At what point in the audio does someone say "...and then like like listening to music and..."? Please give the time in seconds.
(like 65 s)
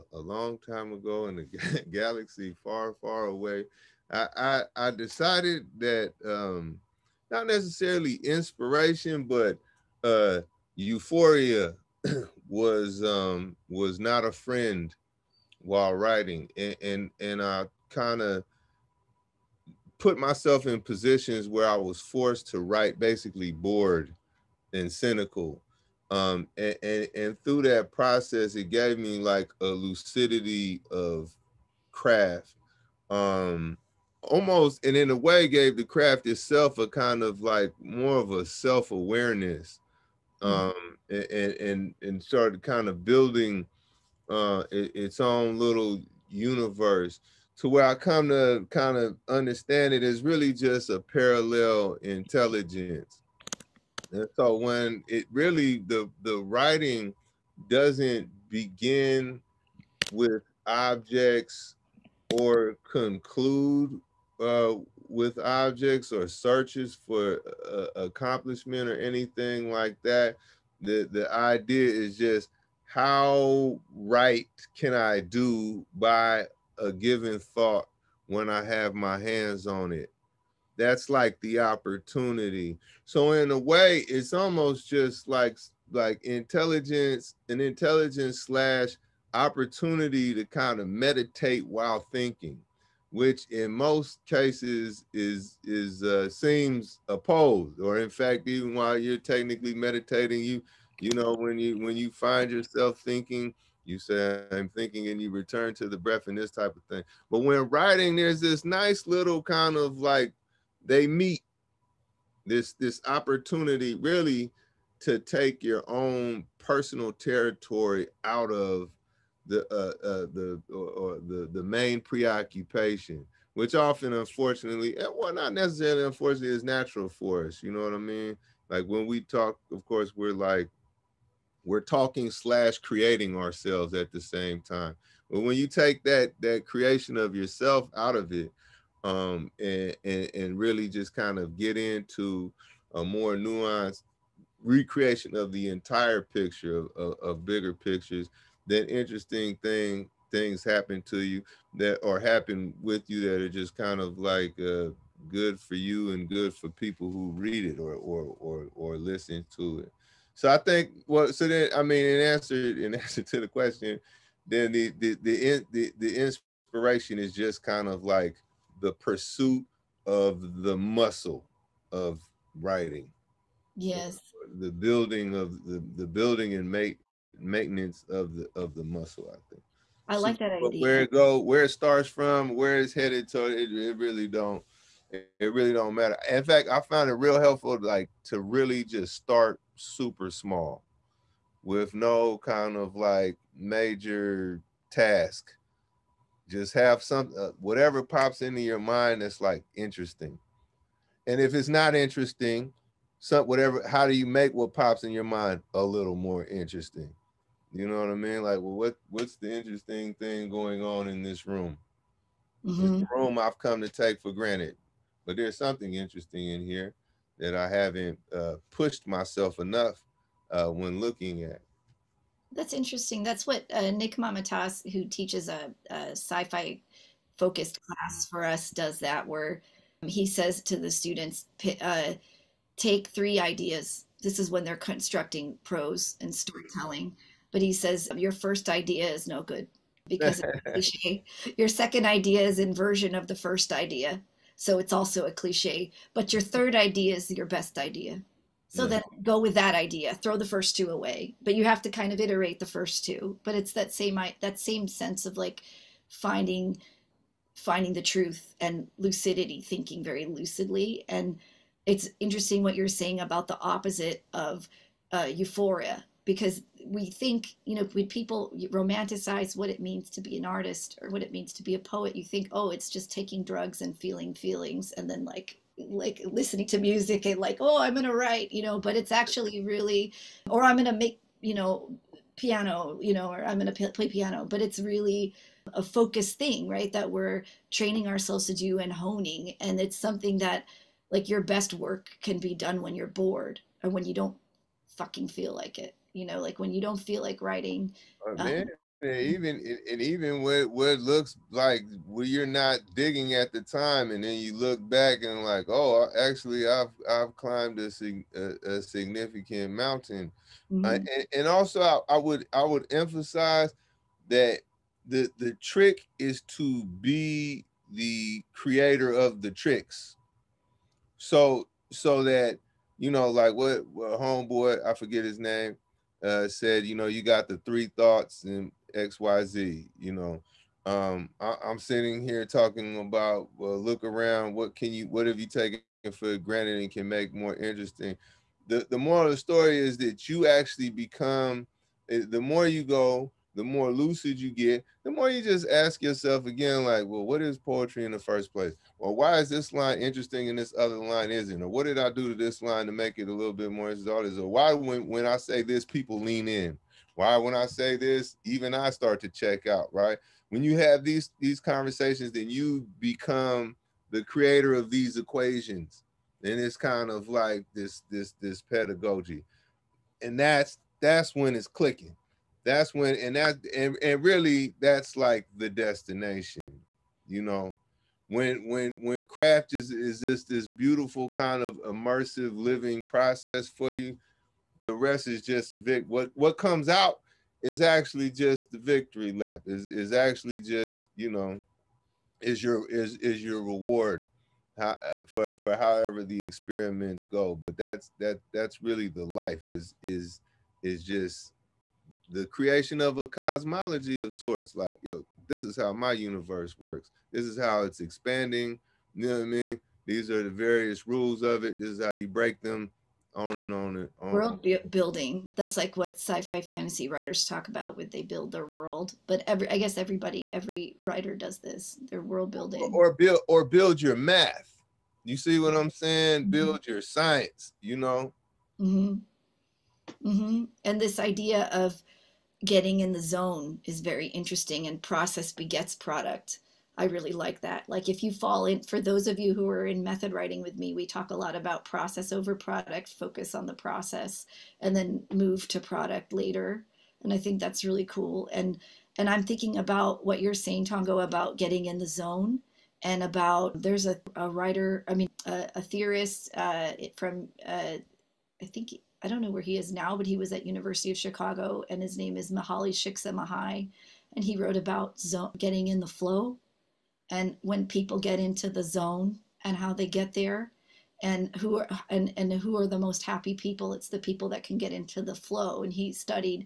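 274 s.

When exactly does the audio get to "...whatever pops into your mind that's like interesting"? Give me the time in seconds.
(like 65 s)
197 s.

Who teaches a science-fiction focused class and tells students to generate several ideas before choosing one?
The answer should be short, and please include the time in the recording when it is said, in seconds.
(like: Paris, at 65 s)
Nick Mamatas, at 223 s.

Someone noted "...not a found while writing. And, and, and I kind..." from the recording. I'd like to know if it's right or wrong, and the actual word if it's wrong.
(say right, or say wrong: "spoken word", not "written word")
wrong: "friend", not "found".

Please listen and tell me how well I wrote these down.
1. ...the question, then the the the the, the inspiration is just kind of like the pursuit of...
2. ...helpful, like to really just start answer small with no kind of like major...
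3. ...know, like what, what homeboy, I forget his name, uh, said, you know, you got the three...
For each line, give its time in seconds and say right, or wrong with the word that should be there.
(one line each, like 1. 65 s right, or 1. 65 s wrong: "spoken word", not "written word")
1. 163 s right
2. 187 s wrong: "super", not "answer"
3. 323 s right.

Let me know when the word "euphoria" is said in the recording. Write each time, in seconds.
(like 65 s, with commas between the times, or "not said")
10 s, 265 s.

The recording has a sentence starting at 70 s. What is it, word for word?
The the idea is just how right can I do by a given thought when I have my hands on it.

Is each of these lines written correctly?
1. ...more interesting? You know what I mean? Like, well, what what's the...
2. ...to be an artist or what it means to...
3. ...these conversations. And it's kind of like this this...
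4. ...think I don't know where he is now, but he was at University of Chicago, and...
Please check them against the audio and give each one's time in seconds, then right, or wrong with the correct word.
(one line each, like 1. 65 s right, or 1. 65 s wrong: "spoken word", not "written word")
1. 206 s right
2. 270 s right
3. 364 s wrong: "equations", not "conversations"
4. 458 s right.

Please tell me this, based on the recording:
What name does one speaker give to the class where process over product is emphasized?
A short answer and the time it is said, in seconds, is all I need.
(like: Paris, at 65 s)
Method writing, at 440 s.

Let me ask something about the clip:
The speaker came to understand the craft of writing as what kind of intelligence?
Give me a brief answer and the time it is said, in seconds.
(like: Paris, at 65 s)
Parallel intelligence, at 50 s.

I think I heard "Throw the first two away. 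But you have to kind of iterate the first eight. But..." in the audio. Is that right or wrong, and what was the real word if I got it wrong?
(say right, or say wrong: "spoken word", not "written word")
wrong: "two", not "eight".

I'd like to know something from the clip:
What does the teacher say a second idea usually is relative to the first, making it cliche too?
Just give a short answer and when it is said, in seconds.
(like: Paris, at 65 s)
Inversion, at 242 s.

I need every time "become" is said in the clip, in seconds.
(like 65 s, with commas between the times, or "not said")
340 s, 362 s.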